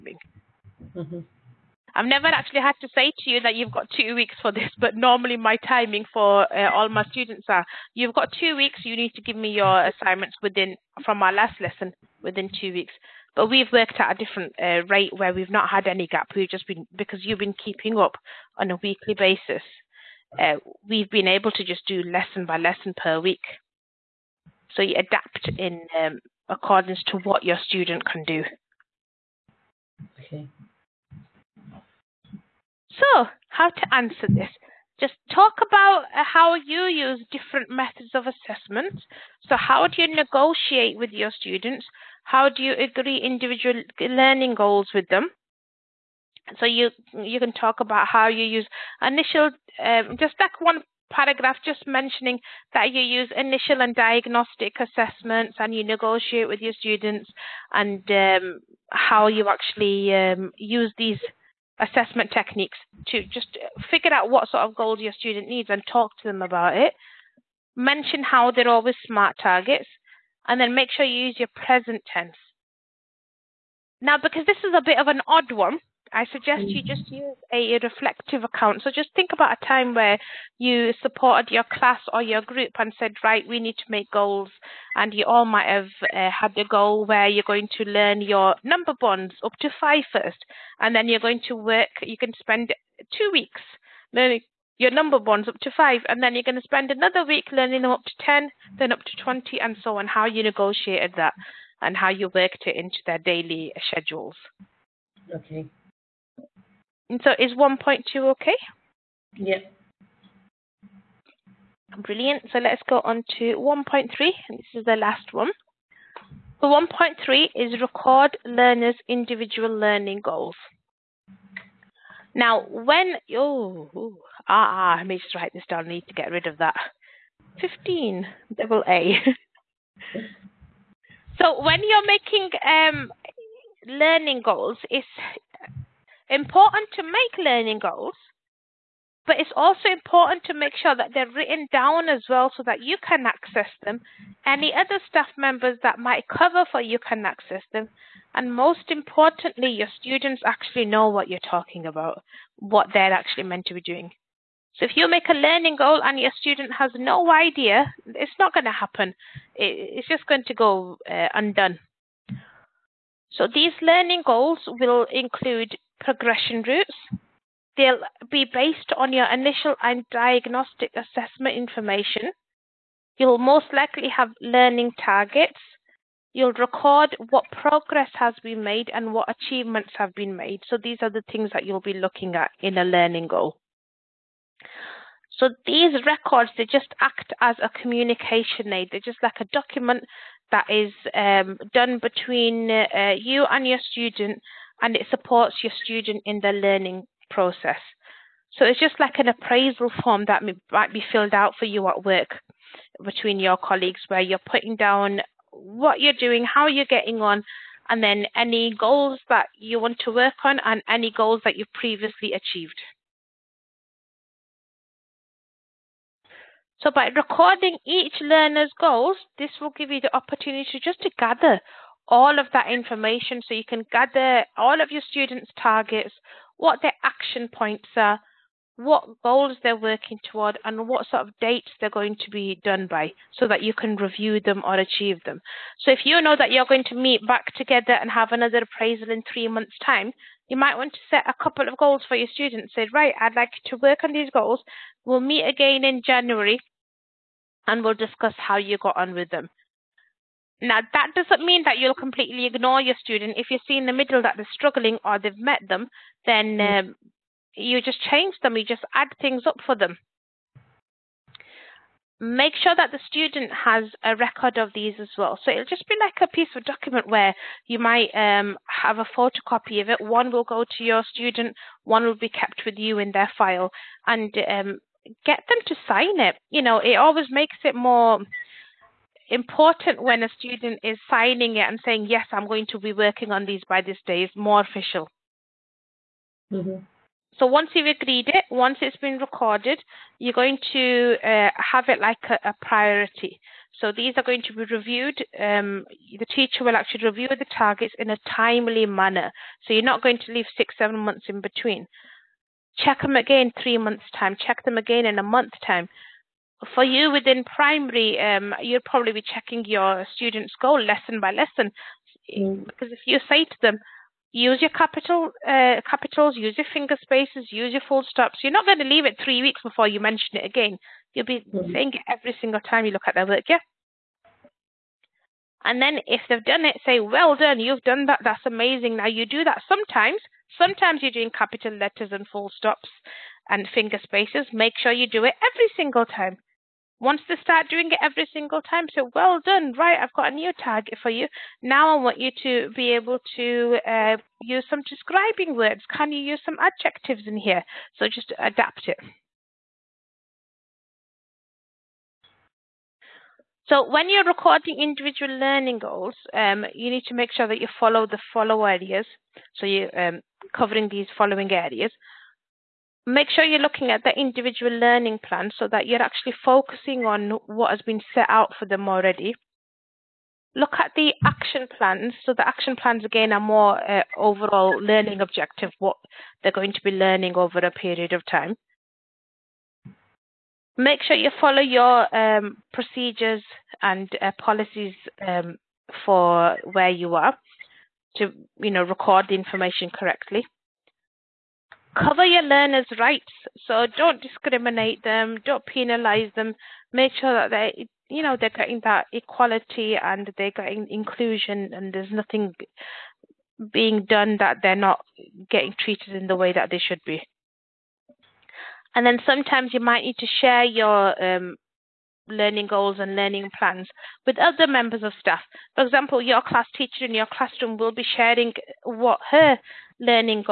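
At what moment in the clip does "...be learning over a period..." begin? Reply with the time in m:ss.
6:16.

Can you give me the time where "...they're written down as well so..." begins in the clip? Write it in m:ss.
2:21.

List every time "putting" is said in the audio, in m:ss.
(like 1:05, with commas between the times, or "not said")
3:24.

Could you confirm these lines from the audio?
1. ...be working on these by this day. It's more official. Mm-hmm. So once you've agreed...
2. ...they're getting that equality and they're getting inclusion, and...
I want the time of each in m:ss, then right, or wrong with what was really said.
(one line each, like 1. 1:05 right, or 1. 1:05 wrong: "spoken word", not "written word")
1. 4:42 right
2. 6:38 right.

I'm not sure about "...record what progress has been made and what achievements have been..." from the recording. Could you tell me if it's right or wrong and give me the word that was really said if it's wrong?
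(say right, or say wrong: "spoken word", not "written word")
right.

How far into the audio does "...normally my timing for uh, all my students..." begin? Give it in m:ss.
0:04.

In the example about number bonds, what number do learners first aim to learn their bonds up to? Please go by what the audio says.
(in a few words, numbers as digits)
5.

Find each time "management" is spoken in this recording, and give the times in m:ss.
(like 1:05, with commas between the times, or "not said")
not said.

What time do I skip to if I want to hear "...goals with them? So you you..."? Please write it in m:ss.
0:44.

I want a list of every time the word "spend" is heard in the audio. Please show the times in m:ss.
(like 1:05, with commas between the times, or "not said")
1:32, 1:36.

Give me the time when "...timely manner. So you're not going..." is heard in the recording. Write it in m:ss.
4:58.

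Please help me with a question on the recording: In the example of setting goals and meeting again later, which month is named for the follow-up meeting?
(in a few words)
January.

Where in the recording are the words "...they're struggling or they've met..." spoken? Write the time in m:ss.
4:14.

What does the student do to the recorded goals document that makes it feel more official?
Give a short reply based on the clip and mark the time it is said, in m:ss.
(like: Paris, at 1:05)
Sign it, at 4:35.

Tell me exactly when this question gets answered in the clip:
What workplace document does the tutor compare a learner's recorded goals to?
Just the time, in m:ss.
3:19.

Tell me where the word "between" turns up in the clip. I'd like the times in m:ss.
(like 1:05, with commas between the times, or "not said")
3:12, 3:23, 5:01.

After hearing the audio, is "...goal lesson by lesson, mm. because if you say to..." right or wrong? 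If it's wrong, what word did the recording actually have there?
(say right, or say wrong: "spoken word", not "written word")
right.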